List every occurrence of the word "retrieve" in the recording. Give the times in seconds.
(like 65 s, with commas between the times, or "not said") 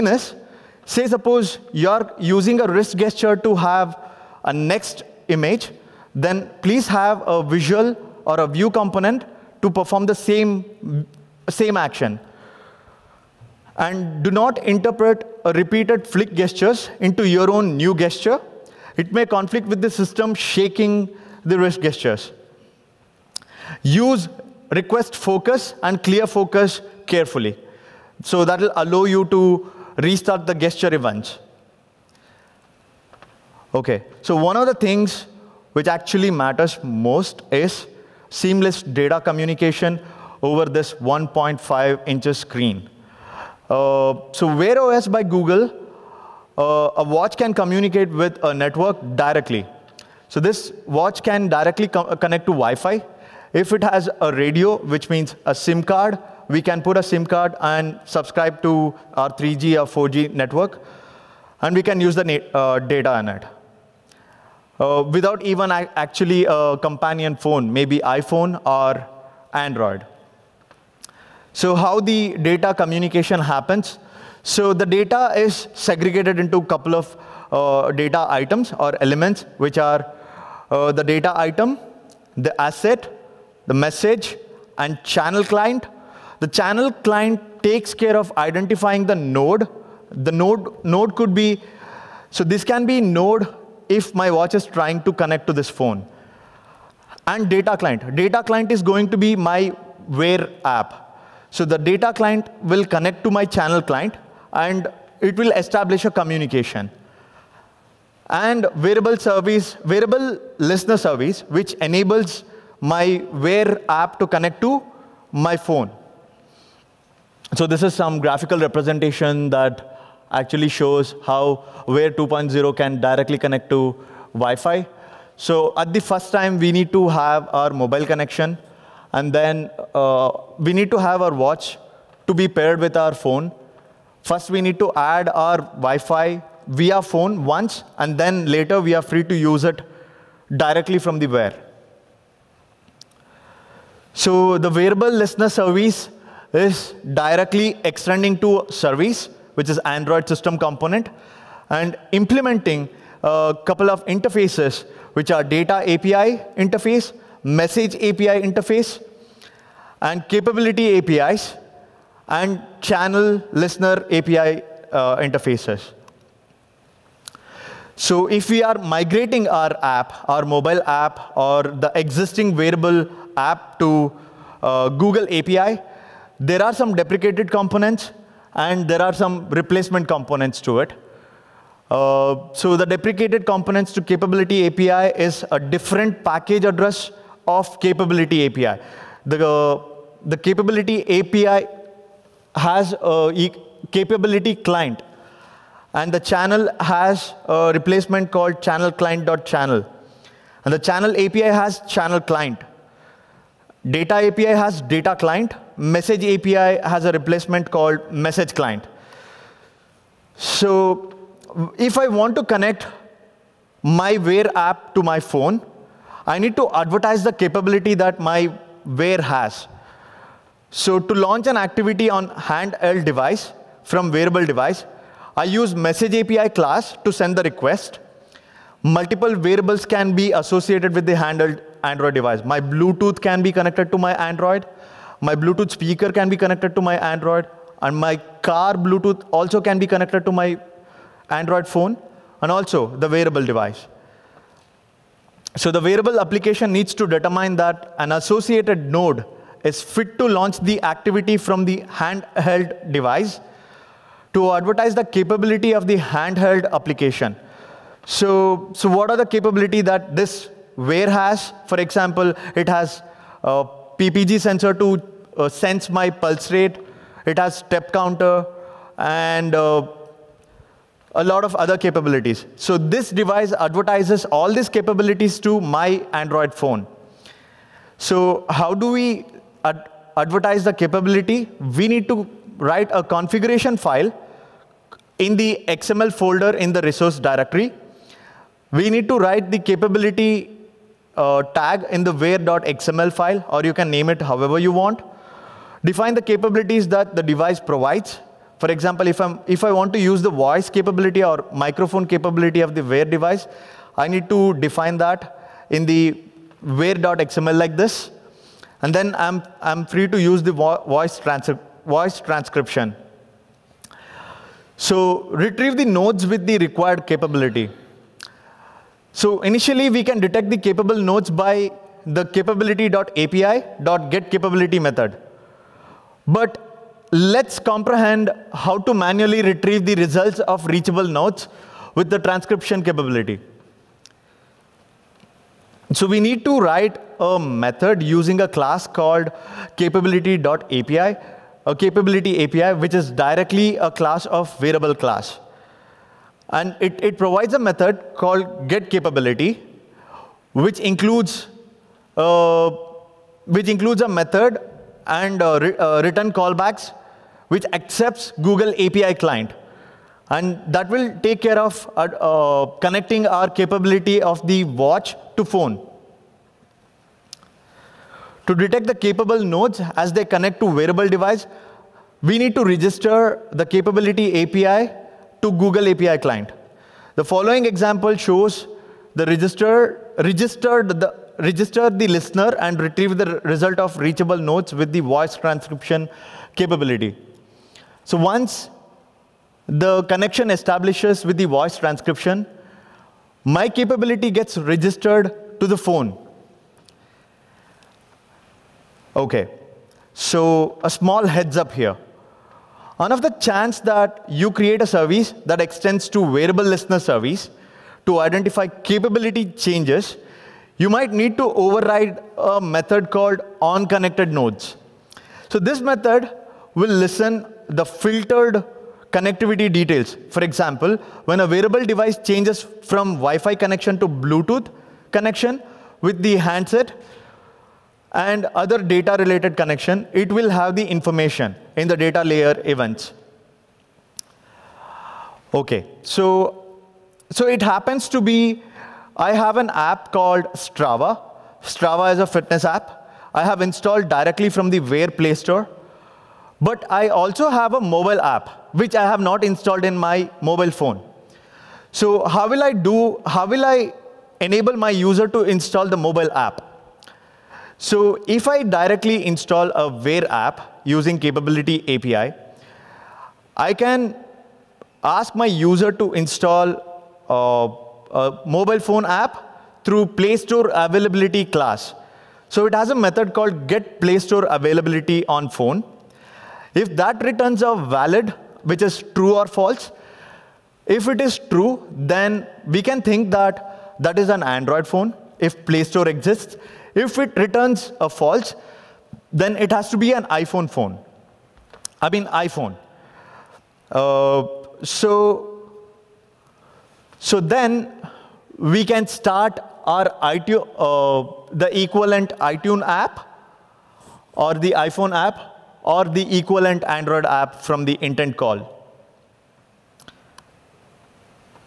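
315 s, 329 s, 382 s.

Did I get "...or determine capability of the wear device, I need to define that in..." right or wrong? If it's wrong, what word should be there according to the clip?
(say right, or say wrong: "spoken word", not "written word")
wrong: "microphone", not "determine".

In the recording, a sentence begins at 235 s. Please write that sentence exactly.
My Bluetooth speaker can be connected to my Android.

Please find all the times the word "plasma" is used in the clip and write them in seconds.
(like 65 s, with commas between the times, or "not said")
not said.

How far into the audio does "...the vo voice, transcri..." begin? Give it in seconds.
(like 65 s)
310 s.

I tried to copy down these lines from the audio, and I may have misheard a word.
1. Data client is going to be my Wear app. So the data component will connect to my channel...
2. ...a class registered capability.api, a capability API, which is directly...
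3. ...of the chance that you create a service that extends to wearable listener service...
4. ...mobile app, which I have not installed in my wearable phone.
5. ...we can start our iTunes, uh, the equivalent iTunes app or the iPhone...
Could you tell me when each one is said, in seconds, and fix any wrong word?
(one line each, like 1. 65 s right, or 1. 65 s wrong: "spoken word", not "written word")
1. 98 s wrong: "client", not "component"
2. 338 s wrong: "called", not "registered"
3. 403 s right
4. 447 s wrong: "mobile", not "wearable"
5. 498 s right.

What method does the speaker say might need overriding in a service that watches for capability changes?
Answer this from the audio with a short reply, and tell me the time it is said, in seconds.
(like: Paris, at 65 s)
on connected nodes, at 413 s.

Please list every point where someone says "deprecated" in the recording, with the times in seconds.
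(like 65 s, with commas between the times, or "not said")
176 s, 182 s.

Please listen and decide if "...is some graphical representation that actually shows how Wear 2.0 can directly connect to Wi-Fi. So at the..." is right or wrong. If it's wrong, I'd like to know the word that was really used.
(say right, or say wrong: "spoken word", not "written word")
right.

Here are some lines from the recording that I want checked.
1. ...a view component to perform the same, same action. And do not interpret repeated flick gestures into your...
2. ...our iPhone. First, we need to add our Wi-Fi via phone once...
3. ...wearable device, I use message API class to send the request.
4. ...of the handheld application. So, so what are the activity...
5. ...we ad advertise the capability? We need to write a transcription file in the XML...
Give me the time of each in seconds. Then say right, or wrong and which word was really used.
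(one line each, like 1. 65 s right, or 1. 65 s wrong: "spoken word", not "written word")
1. 8 s right
2. 132 s wrong: "phone", not "iPhone"
3. 224 s right
4. 255 s wrong: "capability", not "activity"
5. 278 s wrong: "configuration", not "transcription".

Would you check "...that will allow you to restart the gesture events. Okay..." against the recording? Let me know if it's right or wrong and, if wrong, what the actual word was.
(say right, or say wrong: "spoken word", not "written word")
right.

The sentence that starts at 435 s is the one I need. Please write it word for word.
Okay, so, so it happens to be, I have an app called Strava.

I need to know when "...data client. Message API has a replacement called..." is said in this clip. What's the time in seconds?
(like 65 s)
204 s.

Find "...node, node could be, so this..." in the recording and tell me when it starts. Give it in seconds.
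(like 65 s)
90 s.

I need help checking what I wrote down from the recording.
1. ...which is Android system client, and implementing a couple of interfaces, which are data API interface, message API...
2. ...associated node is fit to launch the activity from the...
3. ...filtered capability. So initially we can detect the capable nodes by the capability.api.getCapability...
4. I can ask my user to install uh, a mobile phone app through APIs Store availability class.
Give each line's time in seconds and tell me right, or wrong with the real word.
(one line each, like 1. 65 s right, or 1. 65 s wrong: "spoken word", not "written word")
1. 149 s wrong: "component", not "client"
2. 248 s right
3. 316 s wrong: "required", not "filtered"
4. 463 s wrong: "Play", not "APIs".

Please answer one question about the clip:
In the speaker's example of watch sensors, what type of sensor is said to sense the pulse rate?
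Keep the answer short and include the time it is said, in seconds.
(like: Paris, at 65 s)
PPG sensor, at 263 s.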